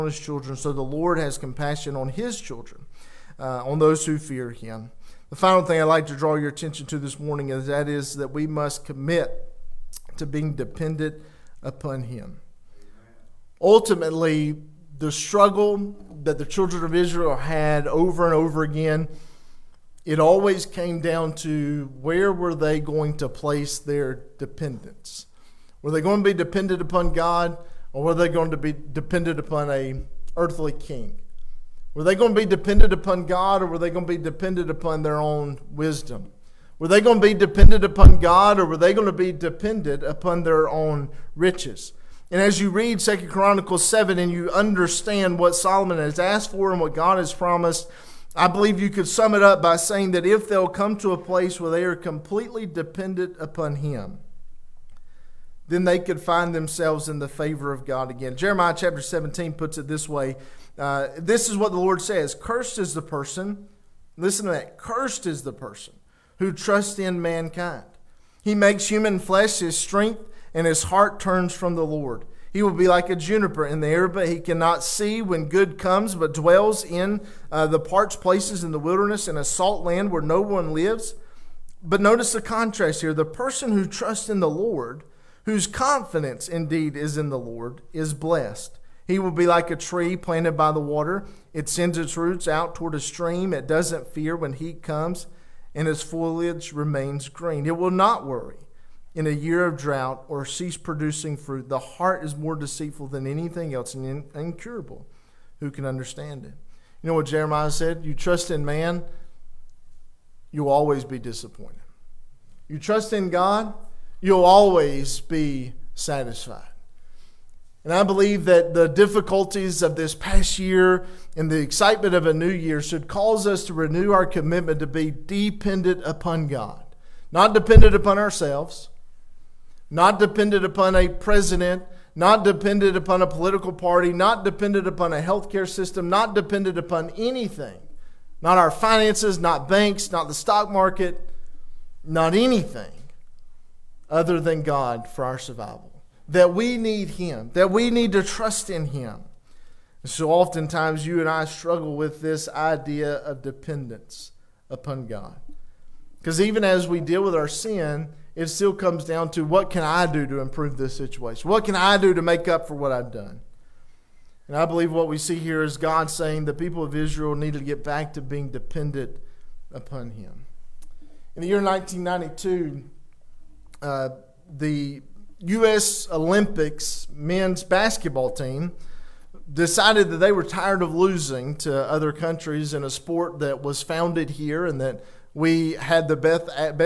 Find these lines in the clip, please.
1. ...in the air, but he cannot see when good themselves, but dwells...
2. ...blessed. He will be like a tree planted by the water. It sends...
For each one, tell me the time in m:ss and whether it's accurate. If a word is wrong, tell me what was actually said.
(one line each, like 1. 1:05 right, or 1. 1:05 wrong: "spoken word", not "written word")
1. 1:13 wrong: "comes", not "themselves"
2. 1:28 right.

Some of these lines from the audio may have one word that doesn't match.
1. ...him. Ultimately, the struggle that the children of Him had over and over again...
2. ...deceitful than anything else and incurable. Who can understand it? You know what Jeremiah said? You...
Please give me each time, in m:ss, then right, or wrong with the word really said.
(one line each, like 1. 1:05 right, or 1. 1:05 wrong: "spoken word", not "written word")
1. 0:12 wrong: "Israel", not "Him"
2. 1:42 right.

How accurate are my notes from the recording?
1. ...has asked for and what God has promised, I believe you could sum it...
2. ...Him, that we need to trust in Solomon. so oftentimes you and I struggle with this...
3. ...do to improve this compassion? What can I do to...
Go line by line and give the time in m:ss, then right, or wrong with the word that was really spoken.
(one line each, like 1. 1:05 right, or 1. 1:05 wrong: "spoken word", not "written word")
1. 0:45 right
2. 2:27 wrong: "Him", not "Solomon"
3. 2:40 wrong: "situation", not "compassion".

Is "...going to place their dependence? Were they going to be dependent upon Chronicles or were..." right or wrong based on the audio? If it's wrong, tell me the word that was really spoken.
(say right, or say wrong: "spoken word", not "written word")
wrong: "God", not "Chronicles".